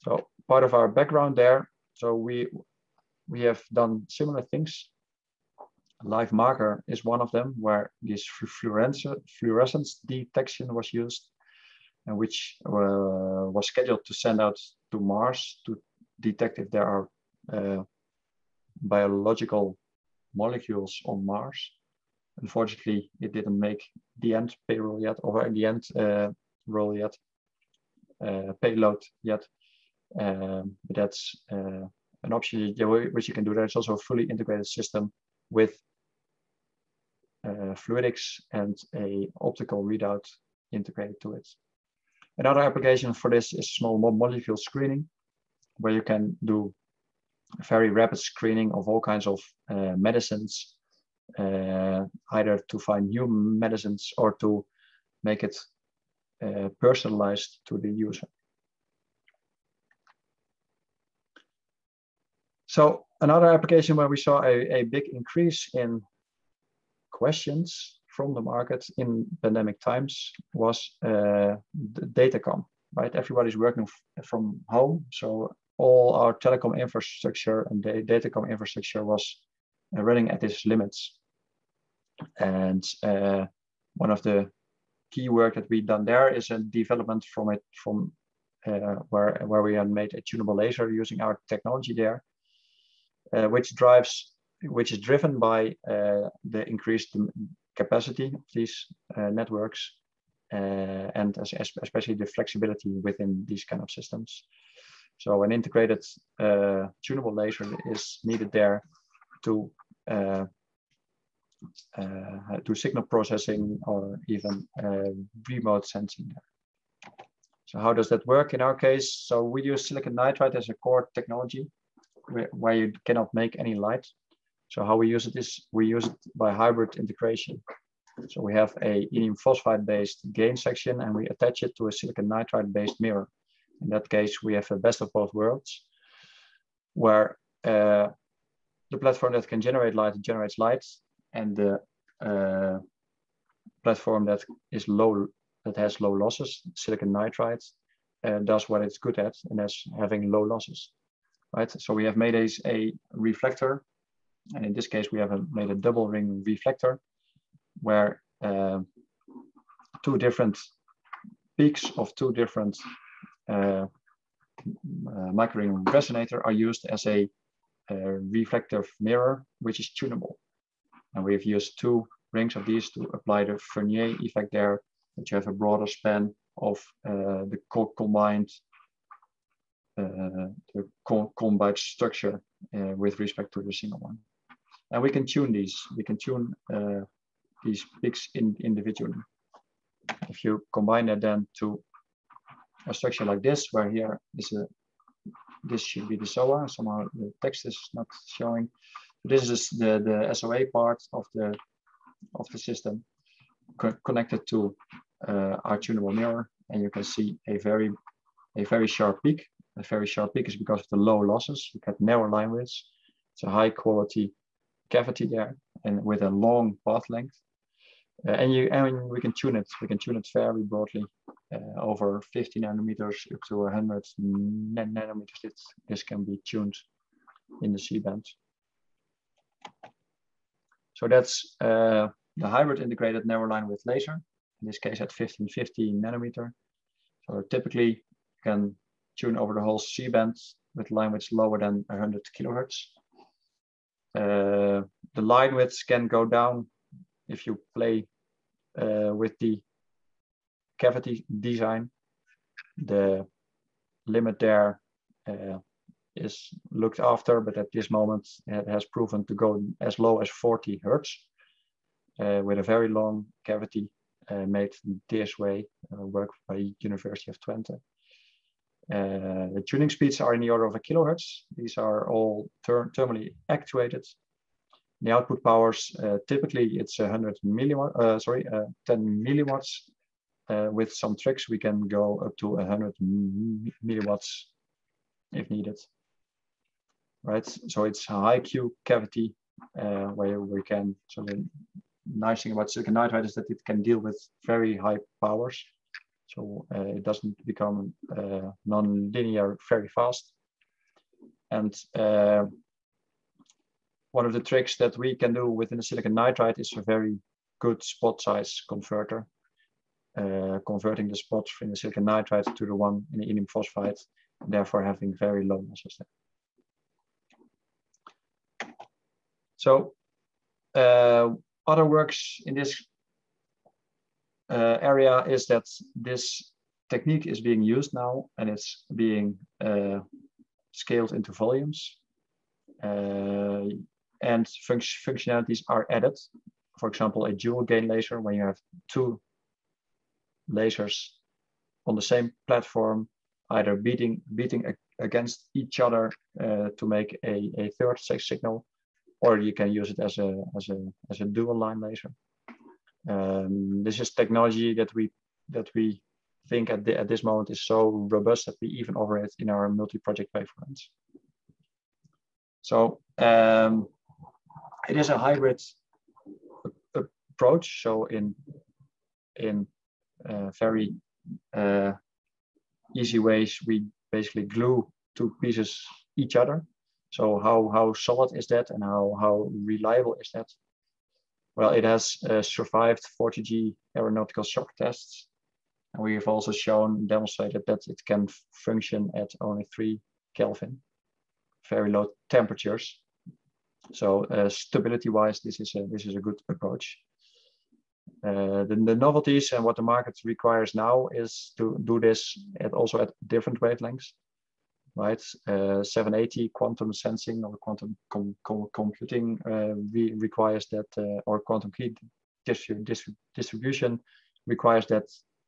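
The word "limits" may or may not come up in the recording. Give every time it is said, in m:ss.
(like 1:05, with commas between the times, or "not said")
1:20, 4:14.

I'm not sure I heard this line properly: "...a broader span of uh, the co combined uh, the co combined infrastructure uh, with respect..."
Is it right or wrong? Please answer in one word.
wrong.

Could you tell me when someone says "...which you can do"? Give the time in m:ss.
0:33.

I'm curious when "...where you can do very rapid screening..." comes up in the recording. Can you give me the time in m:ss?
0:45.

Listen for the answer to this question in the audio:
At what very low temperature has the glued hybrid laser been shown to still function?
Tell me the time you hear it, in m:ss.
6:29.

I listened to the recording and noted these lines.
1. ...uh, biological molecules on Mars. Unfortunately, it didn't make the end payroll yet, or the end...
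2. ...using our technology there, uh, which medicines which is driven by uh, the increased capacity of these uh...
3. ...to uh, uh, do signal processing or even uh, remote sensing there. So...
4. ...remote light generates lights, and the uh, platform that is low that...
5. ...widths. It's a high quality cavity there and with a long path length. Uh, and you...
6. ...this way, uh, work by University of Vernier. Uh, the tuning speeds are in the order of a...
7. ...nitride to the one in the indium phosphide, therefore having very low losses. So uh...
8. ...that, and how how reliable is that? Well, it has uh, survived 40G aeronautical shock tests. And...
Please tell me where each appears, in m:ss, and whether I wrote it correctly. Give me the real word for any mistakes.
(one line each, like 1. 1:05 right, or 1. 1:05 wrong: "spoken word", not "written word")
1. 0:17 right
2. 1:30 wrong: "drives", not "medicines"
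3. 1:49 right
4. 2:19 wrong: "generate", not "remote"
5. 3:32 right
6. 4:25 wrong: "Twente", not "Vernier"
7. 5:12 right
8. 6:18 right.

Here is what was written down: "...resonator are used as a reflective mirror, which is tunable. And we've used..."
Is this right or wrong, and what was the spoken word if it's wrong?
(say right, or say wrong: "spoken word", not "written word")
right.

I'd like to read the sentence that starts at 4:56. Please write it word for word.
So uh, it doesn't become uh, non-linear very fast.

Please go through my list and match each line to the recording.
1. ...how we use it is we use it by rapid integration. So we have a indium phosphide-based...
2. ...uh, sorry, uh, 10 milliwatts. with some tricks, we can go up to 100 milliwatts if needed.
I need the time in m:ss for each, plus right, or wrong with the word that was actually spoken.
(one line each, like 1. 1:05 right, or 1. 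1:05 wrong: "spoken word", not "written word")
1. 2:04 wrong: "hybrid", not "rapid"
2. 4:37 right.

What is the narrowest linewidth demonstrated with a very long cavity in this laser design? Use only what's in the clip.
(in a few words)
40 hertz.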